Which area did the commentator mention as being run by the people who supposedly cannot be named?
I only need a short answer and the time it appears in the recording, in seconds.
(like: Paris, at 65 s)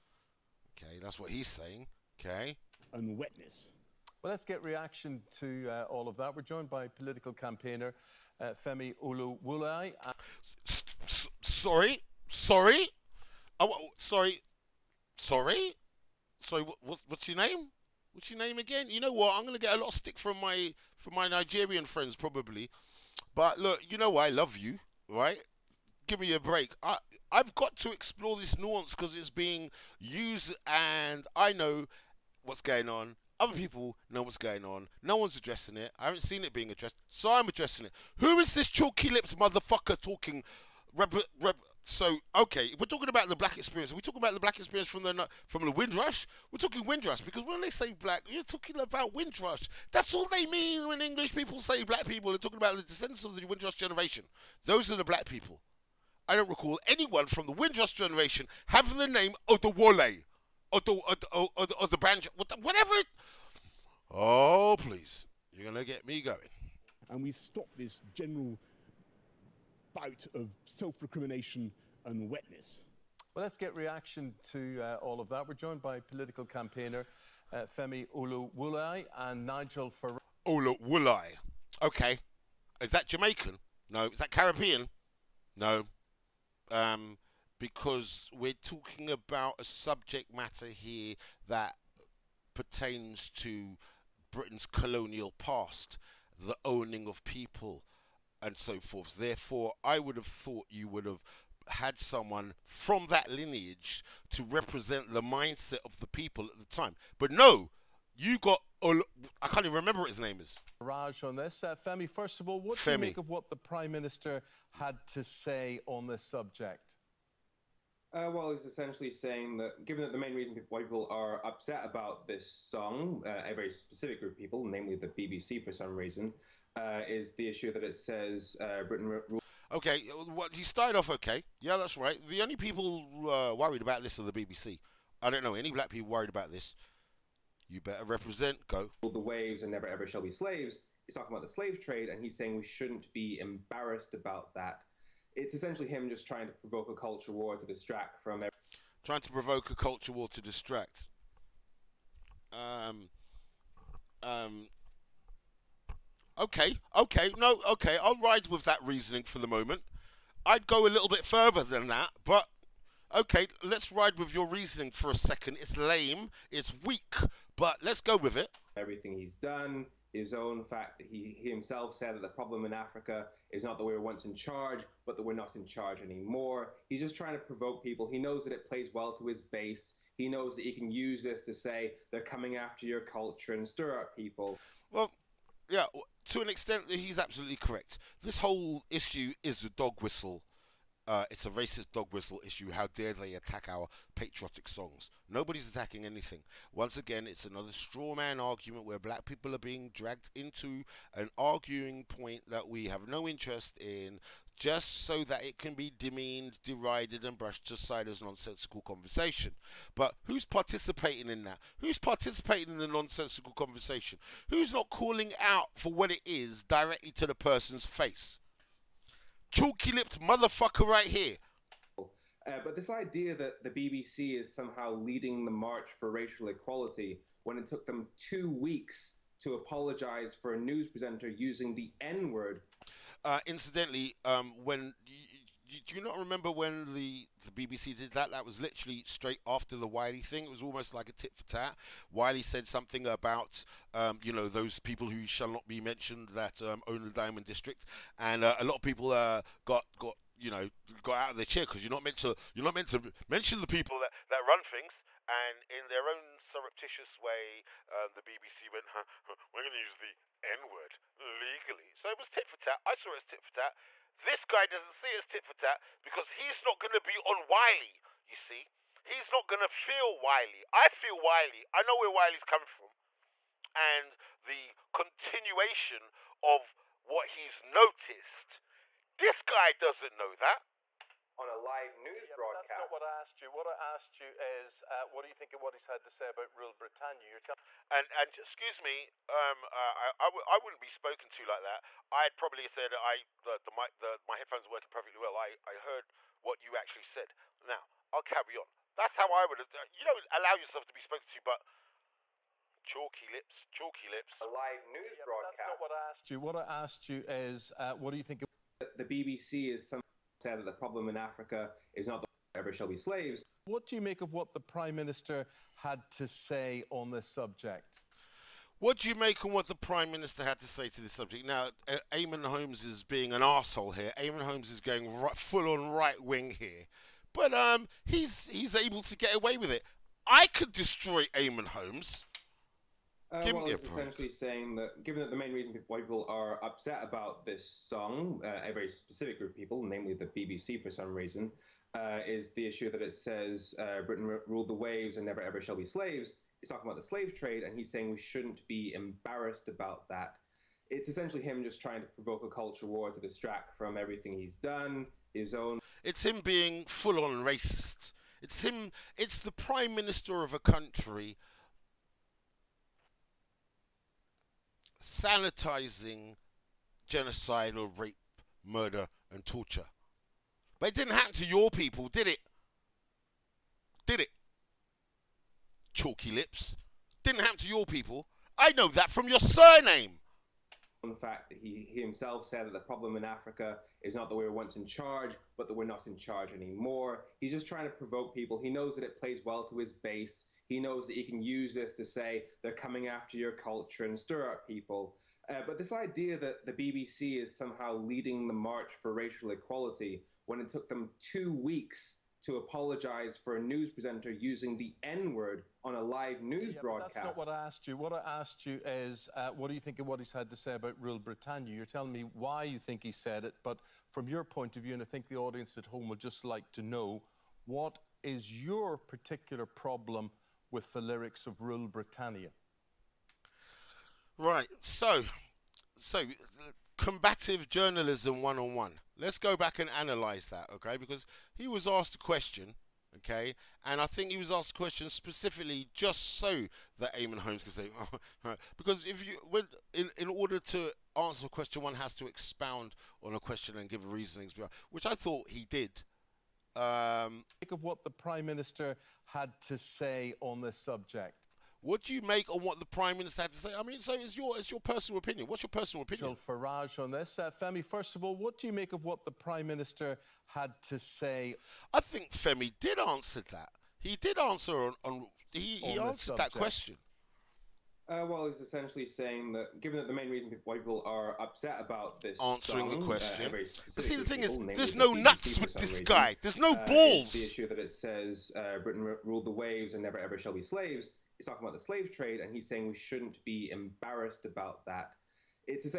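Diamond District, at 247 s.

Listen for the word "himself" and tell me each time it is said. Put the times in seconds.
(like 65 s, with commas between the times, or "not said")
171 s, 382 s.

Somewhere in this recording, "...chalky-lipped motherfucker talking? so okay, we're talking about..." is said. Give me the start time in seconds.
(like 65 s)
38 s.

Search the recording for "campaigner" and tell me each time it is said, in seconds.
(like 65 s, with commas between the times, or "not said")
7 s, 76 s.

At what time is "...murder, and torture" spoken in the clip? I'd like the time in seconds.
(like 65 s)
368 s.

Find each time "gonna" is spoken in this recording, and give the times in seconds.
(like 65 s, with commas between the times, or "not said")
19 s, 65 s.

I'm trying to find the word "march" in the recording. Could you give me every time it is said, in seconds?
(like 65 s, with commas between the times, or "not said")
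225 s, 398 s.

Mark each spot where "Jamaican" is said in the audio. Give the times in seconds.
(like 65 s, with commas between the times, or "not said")
83 s.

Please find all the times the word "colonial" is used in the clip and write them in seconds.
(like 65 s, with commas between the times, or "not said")
94 s.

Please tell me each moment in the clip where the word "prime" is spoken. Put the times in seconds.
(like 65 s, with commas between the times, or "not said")
113 s, 314 s, 319 s, 359 s, 448 s, 452 s, 459 s.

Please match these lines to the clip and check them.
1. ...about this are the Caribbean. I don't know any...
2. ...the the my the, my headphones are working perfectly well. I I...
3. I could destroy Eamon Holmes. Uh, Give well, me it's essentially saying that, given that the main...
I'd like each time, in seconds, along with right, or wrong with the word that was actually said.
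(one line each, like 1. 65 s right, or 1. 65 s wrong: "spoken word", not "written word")
1. 133 s wrong: "BBC", not "Caribbean"
2. 293 s right
3. 330 s right.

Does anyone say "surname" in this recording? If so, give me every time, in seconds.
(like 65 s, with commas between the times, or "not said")
379 s.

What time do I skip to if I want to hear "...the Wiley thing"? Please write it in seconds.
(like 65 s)
239 s.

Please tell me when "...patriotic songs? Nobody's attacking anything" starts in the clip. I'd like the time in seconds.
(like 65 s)
194 s.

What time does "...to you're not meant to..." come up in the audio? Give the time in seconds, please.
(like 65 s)
252 s.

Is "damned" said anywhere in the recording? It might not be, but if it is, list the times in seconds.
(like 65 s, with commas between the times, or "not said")
not said.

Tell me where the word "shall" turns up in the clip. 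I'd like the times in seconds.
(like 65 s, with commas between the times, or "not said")
140 s, 245 s, 312 s, 345 s, 480 s.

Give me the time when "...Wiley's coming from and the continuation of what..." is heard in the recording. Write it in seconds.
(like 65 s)
272 s.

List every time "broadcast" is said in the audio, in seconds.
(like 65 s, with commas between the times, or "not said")
282 s, 305 s, 406 s.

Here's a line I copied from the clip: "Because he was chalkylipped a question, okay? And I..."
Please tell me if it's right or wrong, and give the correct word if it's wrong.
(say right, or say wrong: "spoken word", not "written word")
wrong: "asked", not "chalkylipped".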